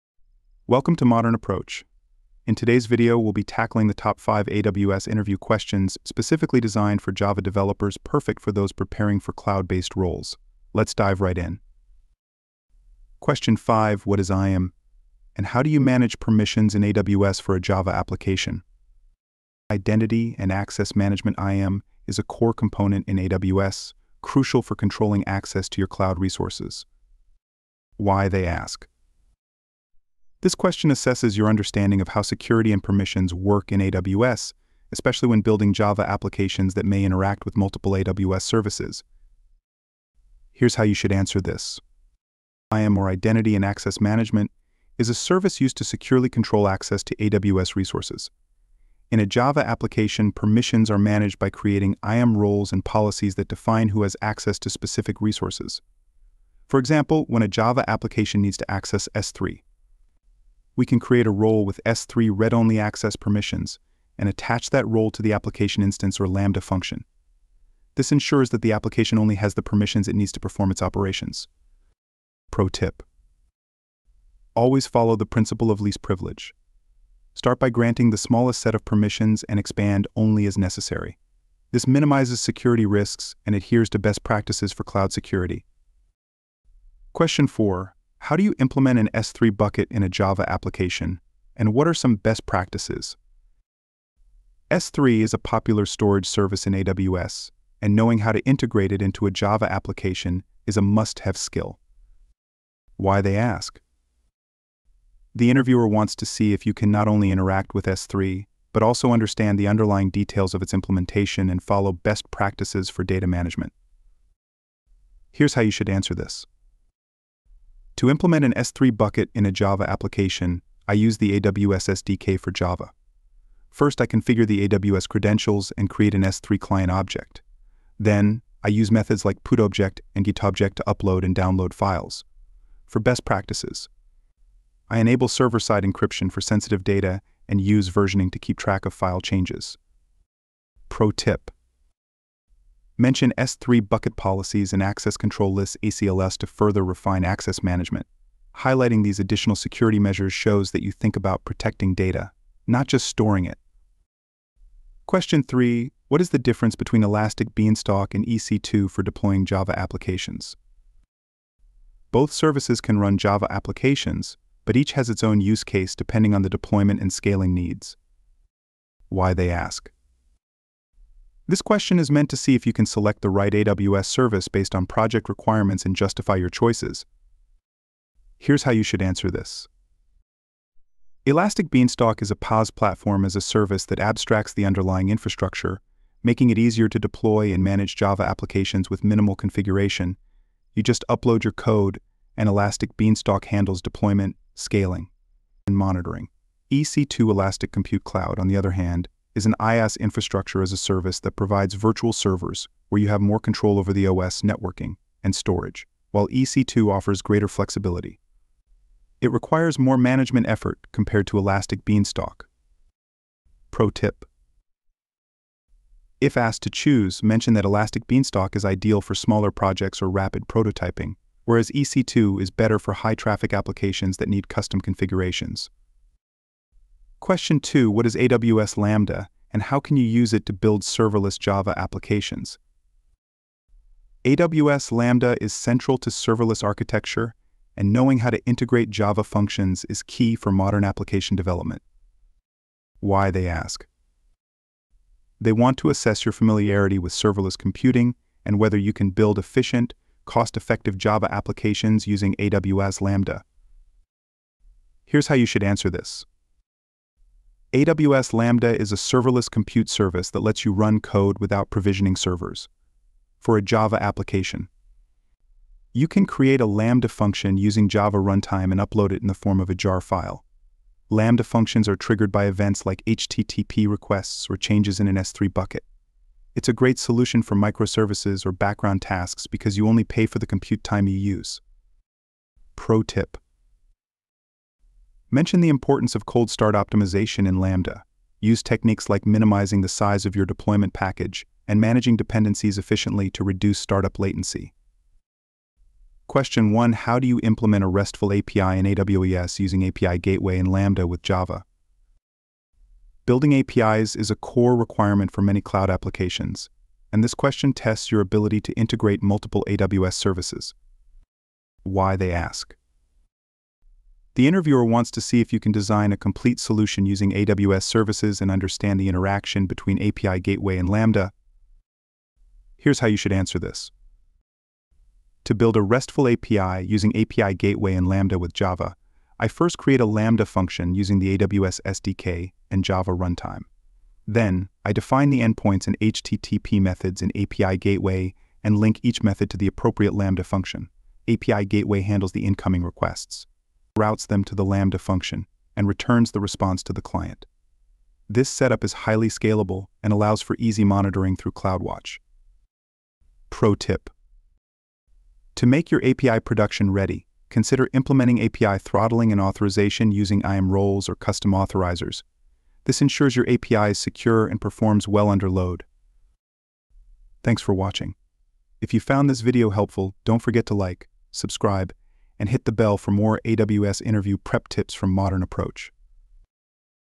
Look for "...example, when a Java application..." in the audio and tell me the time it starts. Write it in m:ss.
0:56.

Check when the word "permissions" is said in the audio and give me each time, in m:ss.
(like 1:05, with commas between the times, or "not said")
0:16, 0:32, 0:50, 1:03, 1:09, 1:18.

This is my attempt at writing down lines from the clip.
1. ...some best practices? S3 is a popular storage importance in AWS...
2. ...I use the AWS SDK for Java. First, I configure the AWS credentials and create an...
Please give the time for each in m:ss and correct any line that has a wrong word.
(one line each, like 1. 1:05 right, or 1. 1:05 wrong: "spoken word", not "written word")
1. 1:31 wrong: "service", not "importance"
2. 2:00 right.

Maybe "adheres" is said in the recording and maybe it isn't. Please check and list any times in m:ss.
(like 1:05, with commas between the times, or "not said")
1:23.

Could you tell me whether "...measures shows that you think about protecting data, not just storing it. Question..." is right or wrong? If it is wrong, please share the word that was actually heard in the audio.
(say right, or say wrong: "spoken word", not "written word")
right.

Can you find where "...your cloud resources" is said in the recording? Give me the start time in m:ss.
0:25.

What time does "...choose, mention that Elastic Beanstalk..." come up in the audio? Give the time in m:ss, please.
3:36.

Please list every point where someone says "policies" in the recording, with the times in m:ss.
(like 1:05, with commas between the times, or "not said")
0:52, 2:24.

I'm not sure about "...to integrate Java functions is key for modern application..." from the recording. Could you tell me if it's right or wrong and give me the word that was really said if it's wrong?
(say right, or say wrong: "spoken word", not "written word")
right.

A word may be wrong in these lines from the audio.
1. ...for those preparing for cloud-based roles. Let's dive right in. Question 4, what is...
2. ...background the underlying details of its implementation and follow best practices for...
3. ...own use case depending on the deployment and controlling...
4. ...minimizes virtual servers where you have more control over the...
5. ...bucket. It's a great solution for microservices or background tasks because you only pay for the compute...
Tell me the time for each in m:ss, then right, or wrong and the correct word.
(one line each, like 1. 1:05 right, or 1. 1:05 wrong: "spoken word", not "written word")
1. 0:08 wrong: "5", not "4"
2. 1:49 wrong: "understand", not "background"
3. 2:45 wrong: "scaling", not "controlling"
4. 3:21 wrong: "provides", not "minimizes"
5. 4:35 right.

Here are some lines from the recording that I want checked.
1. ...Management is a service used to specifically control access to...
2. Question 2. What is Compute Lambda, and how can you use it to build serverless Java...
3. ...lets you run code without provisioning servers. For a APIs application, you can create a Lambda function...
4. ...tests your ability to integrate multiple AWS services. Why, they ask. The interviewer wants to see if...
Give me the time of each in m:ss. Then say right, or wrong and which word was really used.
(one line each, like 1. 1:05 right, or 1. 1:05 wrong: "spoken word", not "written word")
1. 0:44 wrong: "securely", not "specifically"
2. 3:47 wrong: "AWS", not "Compute"
3. 4:20 wrong: "Java", not "APIs"
4. 5:07 right.